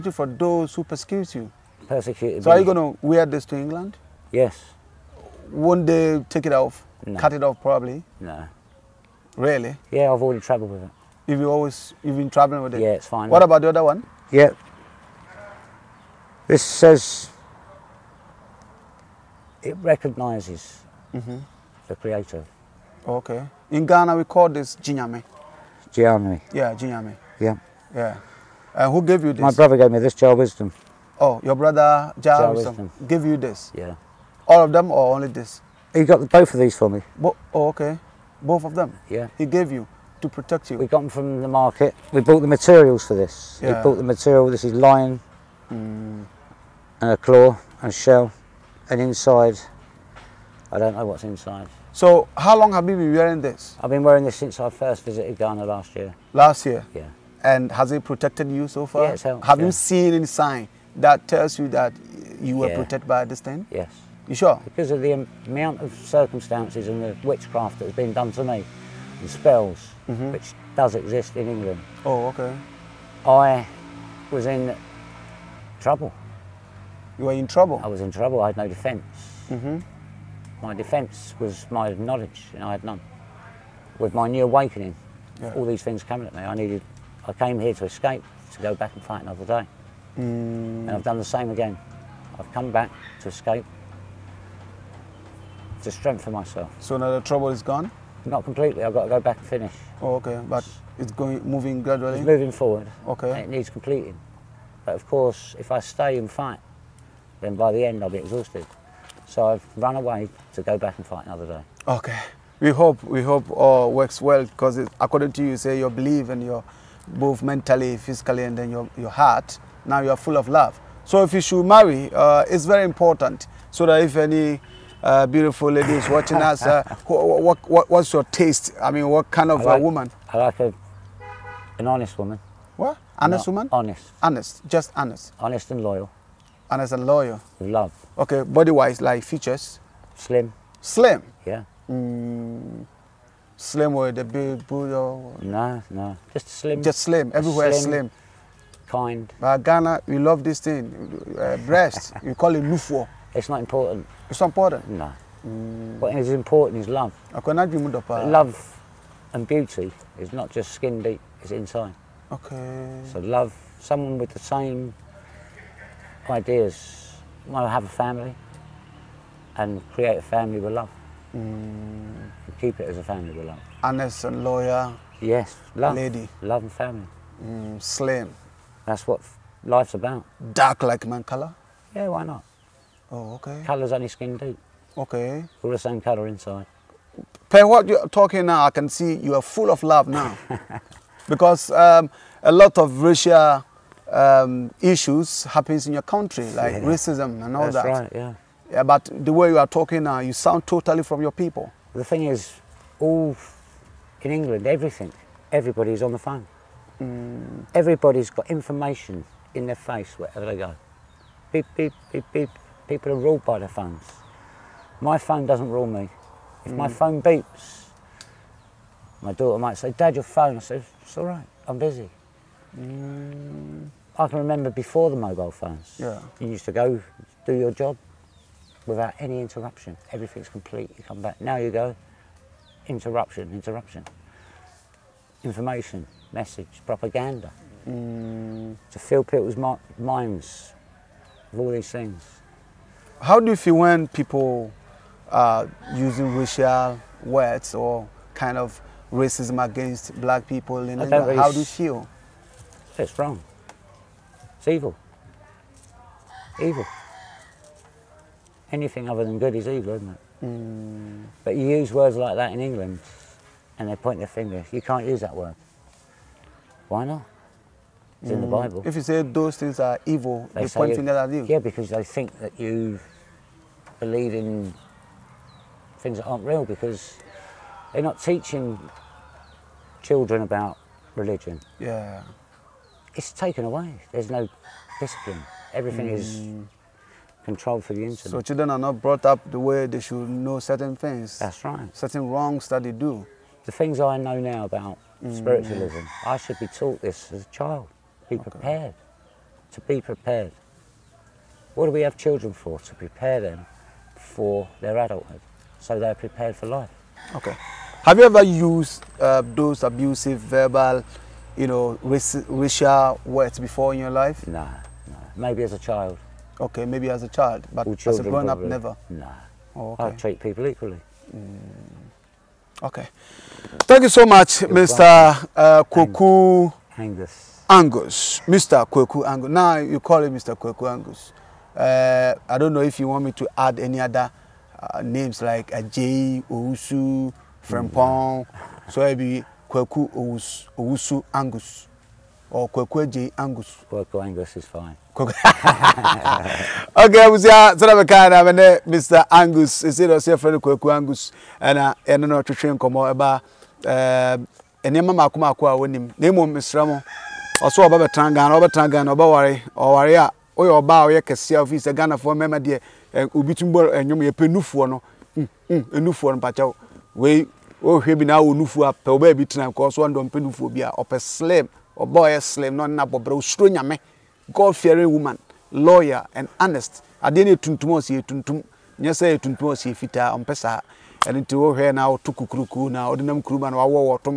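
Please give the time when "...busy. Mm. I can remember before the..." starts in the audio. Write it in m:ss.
3:41.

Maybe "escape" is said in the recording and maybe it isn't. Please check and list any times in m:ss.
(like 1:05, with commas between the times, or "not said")
1:27, 1:33.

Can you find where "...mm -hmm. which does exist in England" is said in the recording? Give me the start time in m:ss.
1:10.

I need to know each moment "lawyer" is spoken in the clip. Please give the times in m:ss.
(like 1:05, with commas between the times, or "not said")
2:54, 6:15.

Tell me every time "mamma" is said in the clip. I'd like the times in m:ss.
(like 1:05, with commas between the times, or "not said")
5:55, 6:02.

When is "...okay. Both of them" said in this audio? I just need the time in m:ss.
0:37.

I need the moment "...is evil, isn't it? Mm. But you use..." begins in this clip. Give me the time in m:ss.
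4:19.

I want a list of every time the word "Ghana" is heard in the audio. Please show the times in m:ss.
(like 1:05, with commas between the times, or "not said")
0:23, 0:55, 2:29, 6:01.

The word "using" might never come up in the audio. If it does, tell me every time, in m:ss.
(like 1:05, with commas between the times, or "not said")
4:05.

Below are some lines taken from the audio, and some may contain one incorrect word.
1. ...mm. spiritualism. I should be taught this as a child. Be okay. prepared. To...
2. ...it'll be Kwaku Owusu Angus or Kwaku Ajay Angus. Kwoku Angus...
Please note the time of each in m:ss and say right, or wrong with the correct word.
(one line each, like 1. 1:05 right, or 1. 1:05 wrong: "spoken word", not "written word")
1. 4:55 right
2. 5:39 right.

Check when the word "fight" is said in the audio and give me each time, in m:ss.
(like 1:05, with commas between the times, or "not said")
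1:29, 1:46, 1:51.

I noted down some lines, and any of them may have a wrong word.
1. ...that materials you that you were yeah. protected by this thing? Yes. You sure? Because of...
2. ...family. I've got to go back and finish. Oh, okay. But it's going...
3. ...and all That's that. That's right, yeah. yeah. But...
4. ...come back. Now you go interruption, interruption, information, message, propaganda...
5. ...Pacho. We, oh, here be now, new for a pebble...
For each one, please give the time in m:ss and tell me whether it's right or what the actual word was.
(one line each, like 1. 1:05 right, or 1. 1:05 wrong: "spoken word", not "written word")
1. 1:00 wrong: "tells", not "materials"
2. 1:38 wrong: "completely", not "family"
3. 3:17 right
4. 3:51 right
5. 6:06 right.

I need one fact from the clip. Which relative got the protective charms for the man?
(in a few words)
Joe Wisdom.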